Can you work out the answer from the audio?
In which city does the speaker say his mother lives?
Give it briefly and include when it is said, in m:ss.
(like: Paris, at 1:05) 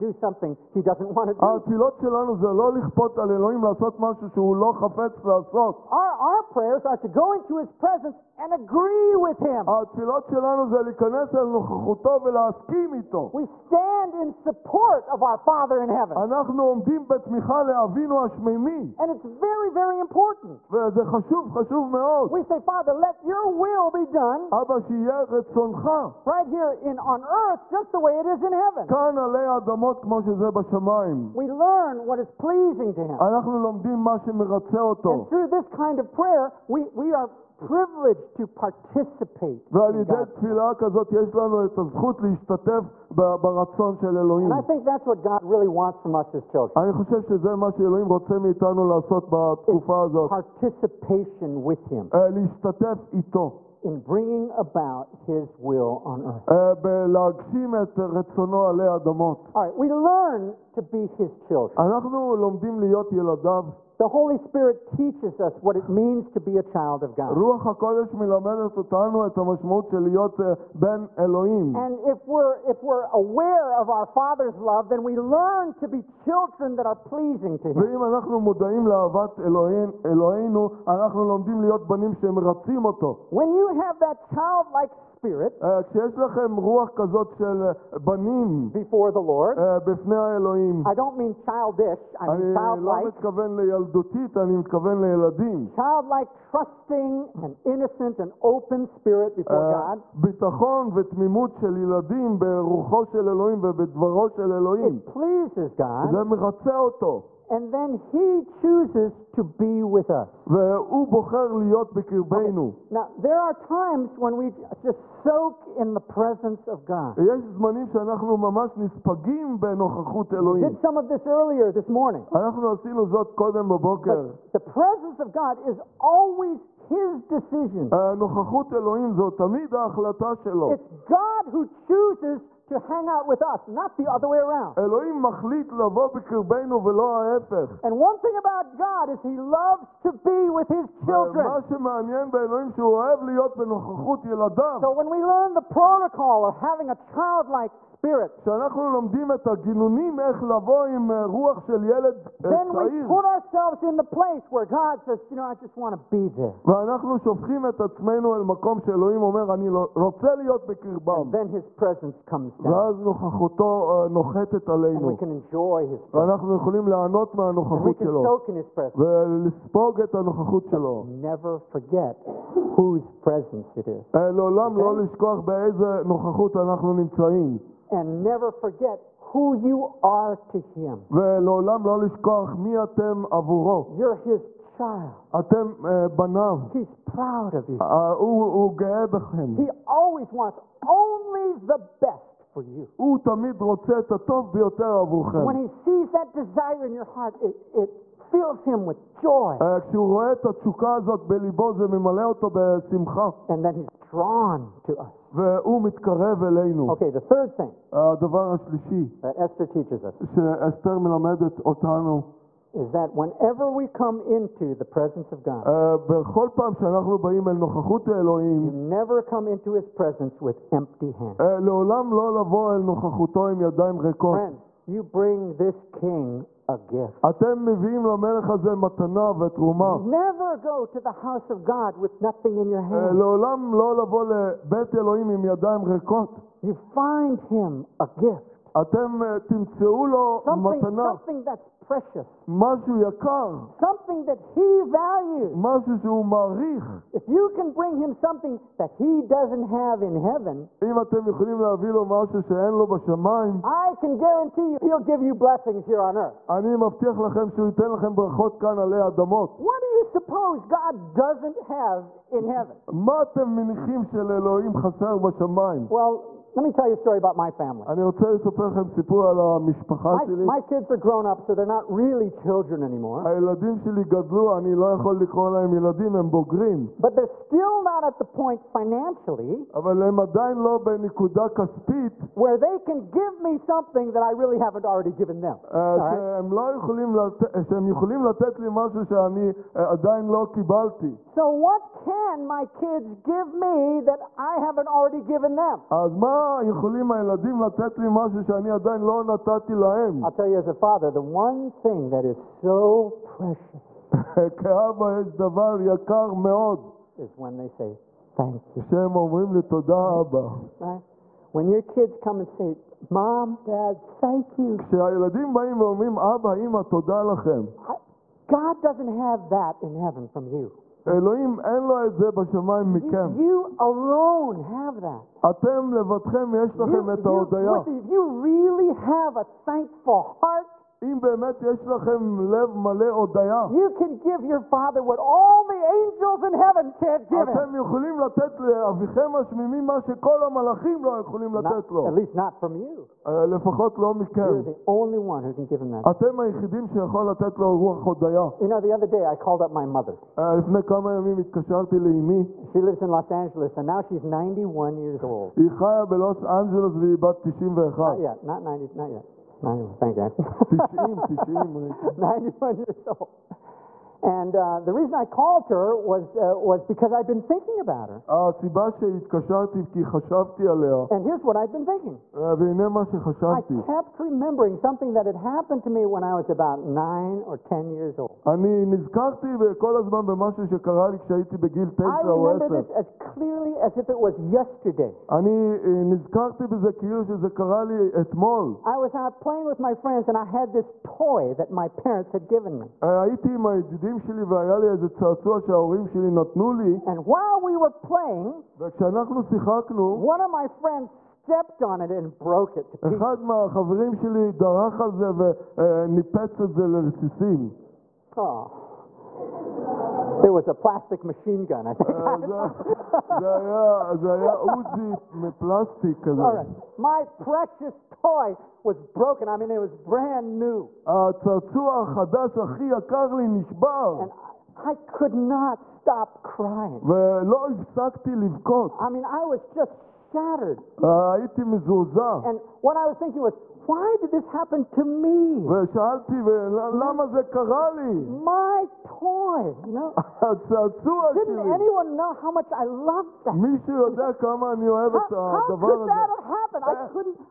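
Los Angeles, at 5:53.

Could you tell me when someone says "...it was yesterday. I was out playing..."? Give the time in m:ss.
6:24.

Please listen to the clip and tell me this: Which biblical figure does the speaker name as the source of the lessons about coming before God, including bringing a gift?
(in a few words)
Esther.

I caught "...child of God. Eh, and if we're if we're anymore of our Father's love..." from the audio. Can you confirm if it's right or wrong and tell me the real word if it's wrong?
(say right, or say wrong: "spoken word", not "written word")
wrong: "aware", not "anymore".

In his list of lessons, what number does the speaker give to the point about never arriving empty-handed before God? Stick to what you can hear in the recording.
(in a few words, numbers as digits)
third.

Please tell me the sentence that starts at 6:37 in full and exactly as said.
And while we were playing, וכשאנחנו שיחקנו, one of my friends stepped on it and broke it to pieces.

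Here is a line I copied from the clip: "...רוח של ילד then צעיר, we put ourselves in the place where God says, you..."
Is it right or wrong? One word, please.
right.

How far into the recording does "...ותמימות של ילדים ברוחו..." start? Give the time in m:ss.
1:40.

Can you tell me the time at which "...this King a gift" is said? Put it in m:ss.
3:45.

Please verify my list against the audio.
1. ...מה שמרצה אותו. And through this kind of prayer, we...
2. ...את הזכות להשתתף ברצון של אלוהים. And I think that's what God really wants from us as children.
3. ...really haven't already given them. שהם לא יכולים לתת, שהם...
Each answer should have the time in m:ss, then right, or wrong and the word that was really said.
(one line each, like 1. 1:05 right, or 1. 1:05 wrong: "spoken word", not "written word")
1. 0:33 right
2. 0:41 right
3. 4:44 right.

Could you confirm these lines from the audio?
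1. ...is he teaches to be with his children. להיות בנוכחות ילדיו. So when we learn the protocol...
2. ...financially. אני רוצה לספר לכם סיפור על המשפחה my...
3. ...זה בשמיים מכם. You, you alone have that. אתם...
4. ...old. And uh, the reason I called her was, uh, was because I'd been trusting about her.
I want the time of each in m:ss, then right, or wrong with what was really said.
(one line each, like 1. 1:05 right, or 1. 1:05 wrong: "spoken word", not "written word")
1. 2:19 wrong: "loves", not "teaches"
2. 4:27 wrong: "family", not "financially"
3. 5:22 right
4. 6:03 wrong: "thinking", not "trusting".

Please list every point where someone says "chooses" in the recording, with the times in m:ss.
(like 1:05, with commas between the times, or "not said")
1:48, 2:11.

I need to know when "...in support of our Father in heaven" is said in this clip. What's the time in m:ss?
0:14.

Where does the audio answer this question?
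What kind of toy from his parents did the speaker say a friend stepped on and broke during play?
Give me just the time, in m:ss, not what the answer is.
6:50.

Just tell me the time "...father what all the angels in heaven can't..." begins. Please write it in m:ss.
5:34.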